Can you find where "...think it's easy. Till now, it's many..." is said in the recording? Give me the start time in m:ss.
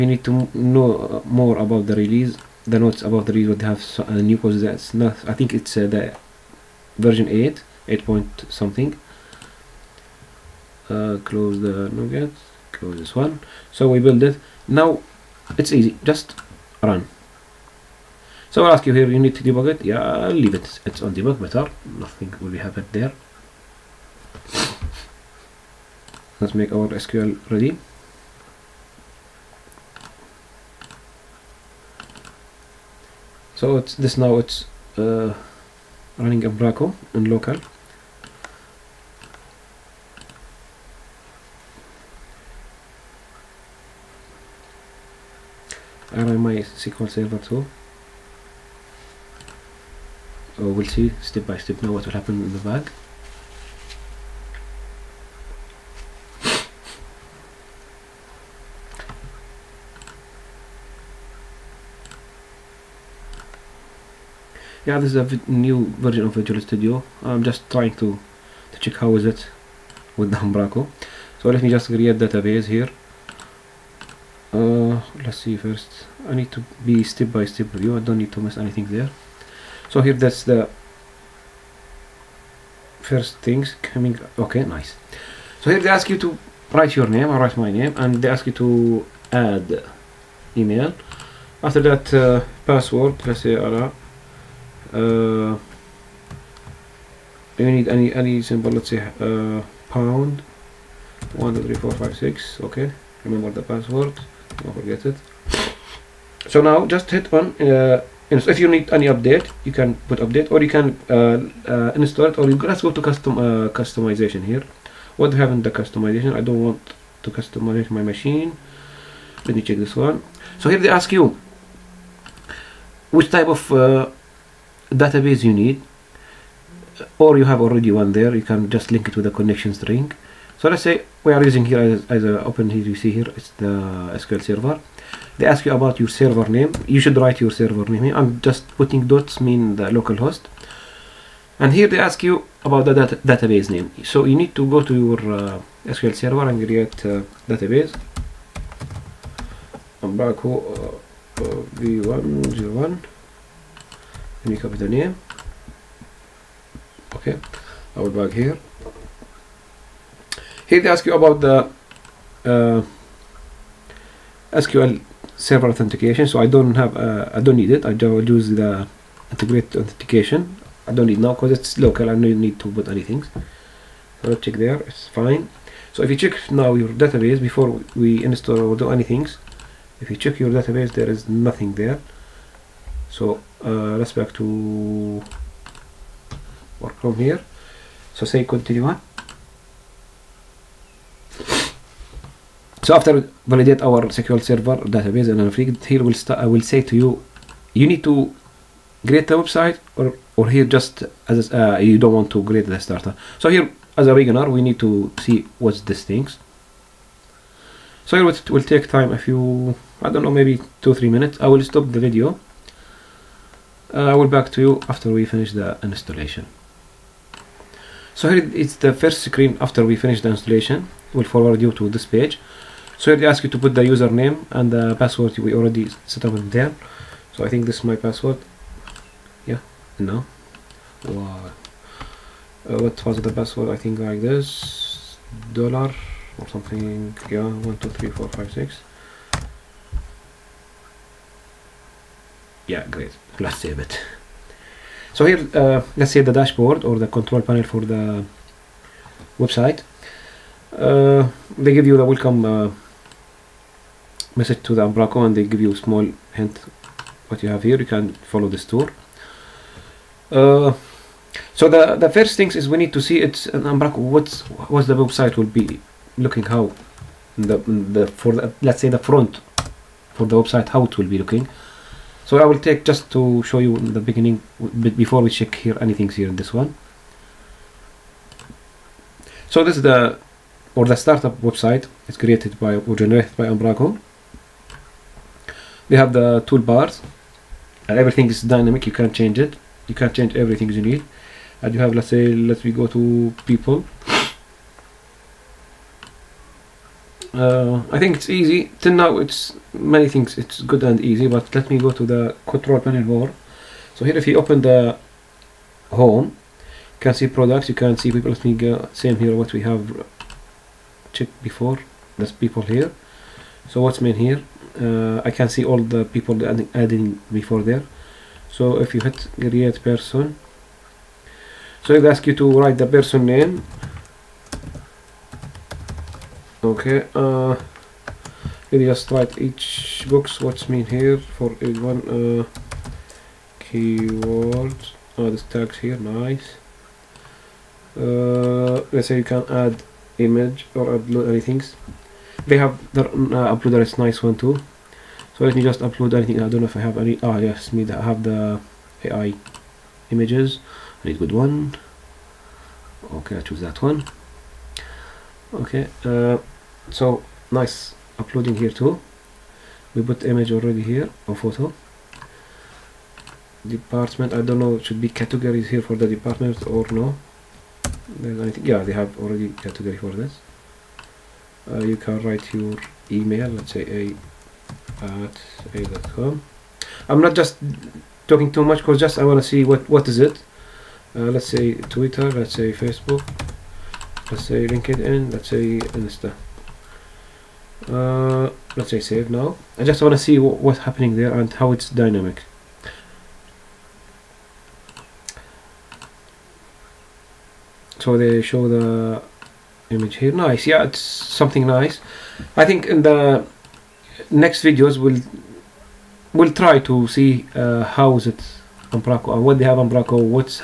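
4:57.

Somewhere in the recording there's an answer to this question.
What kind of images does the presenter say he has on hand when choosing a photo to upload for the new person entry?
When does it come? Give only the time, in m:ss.
5:49.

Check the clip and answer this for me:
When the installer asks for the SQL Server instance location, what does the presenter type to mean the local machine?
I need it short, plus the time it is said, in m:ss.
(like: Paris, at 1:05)
dots, at 2:19.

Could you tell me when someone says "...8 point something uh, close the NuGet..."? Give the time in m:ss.
0:07.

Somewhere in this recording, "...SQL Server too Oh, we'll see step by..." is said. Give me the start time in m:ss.
0:46.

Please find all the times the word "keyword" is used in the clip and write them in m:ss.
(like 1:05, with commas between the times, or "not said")
5:33.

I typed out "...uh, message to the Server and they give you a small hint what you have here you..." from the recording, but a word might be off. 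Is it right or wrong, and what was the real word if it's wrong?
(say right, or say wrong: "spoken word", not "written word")
wrong: "Umbraco", not "Server".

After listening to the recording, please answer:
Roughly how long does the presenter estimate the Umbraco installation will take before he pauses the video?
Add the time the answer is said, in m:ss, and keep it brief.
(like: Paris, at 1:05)
two three minutes, at 3:30.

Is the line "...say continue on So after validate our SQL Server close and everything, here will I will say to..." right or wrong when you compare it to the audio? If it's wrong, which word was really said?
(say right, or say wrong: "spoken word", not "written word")
wrong: "database", not "close".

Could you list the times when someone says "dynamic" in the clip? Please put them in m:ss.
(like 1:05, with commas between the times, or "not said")
4:48, 6:31.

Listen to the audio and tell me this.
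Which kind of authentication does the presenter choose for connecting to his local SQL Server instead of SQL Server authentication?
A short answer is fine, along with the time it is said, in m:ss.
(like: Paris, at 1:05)
integrated authentication, at 2:49.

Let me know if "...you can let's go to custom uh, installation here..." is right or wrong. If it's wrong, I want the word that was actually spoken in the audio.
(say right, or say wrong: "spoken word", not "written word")
wrong: "customization", not "installation".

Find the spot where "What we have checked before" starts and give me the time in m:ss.
5:09.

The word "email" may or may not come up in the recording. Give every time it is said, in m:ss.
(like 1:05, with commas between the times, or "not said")
1:30, 6:13.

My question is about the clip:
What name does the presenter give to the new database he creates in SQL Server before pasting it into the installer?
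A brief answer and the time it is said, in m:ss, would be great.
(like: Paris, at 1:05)
v 101, at 2:31.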